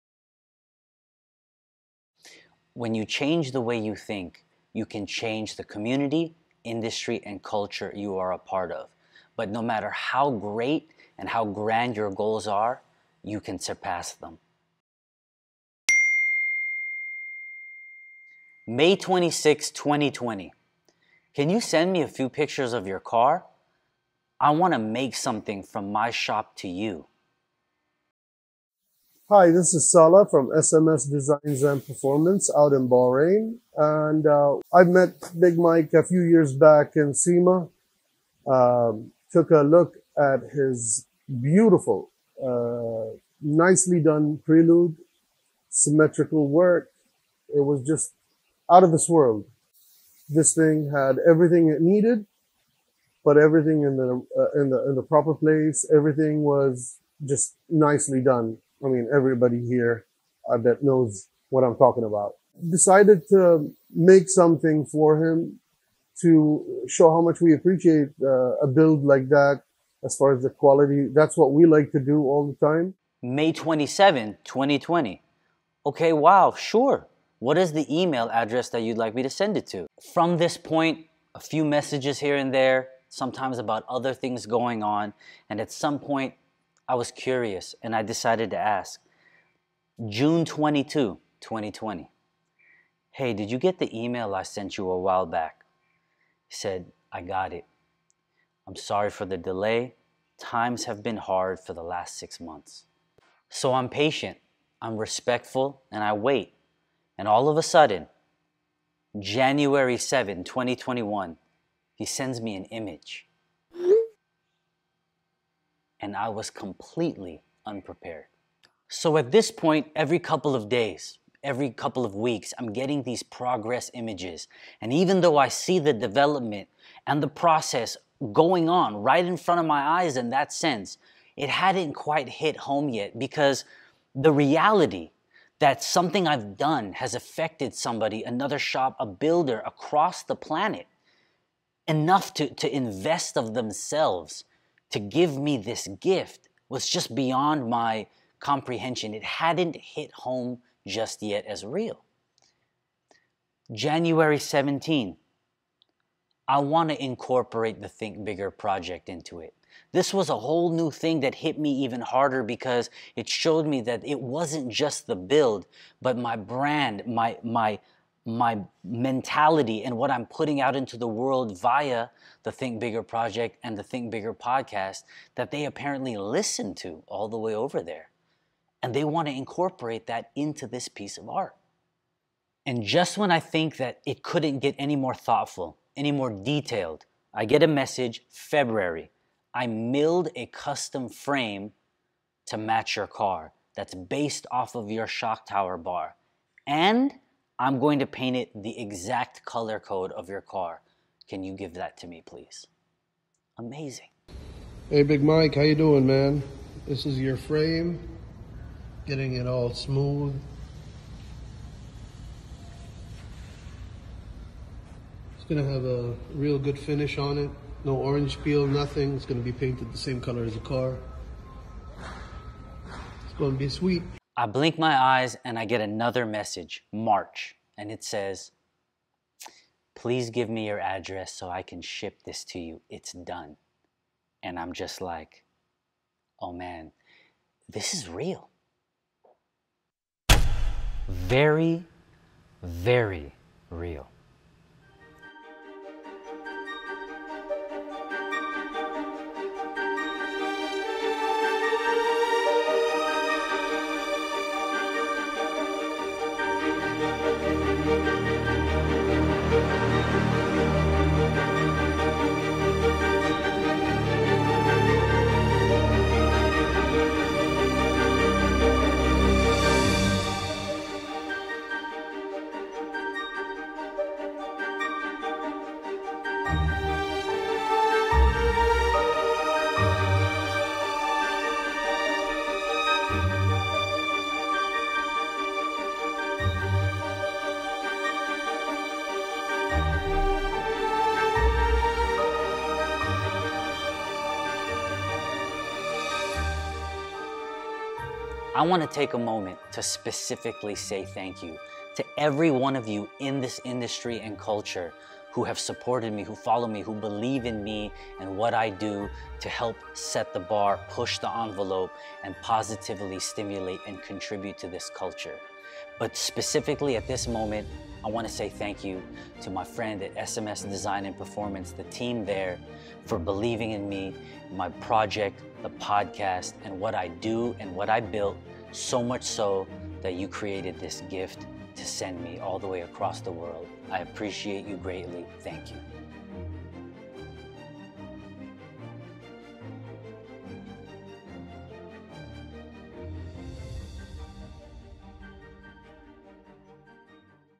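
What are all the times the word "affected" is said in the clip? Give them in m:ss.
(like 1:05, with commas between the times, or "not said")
2:17.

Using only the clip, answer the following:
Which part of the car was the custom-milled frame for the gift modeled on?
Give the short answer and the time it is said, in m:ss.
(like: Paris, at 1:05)
shock tower bar, at 3:15.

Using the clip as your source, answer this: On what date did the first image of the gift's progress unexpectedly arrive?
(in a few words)
January 7, 2021.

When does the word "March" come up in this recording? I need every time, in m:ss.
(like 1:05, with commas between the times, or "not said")
3:46.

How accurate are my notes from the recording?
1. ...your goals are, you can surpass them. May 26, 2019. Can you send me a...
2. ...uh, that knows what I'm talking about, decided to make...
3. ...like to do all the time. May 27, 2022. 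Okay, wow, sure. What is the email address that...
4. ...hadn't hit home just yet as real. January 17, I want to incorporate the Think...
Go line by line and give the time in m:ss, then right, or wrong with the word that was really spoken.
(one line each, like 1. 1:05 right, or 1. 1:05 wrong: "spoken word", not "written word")
1. 0:11 wrong: "2020", not "2019"
2. 1:00 right
3. 1:11 wrong: "2020", not "2022"
4. 2:29 right.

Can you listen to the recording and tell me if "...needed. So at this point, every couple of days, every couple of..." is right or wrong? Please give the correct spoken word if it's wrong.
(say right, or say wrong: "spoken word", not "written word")
wrong: "unprepared", not "needed".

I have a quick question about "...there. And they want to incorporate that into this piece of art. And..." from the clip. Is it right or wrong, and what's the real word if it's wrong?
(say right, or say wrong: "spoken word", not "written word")
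right.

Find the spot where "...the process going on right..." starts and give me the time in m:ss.
2:07.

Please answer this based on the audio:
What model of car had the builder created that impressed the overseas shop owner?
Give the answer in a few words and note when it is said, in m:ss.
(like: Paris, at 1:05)
Prelude, at 0:44.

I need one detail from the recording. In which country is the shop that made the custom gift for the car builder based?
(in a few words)
Bahrain.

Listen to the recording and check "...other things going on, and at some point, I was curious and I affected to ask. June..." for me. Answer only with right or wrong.
wrong.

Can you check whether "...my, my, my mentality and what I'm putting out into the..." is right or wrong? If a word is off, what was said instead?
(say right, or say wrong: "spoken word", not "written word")
right.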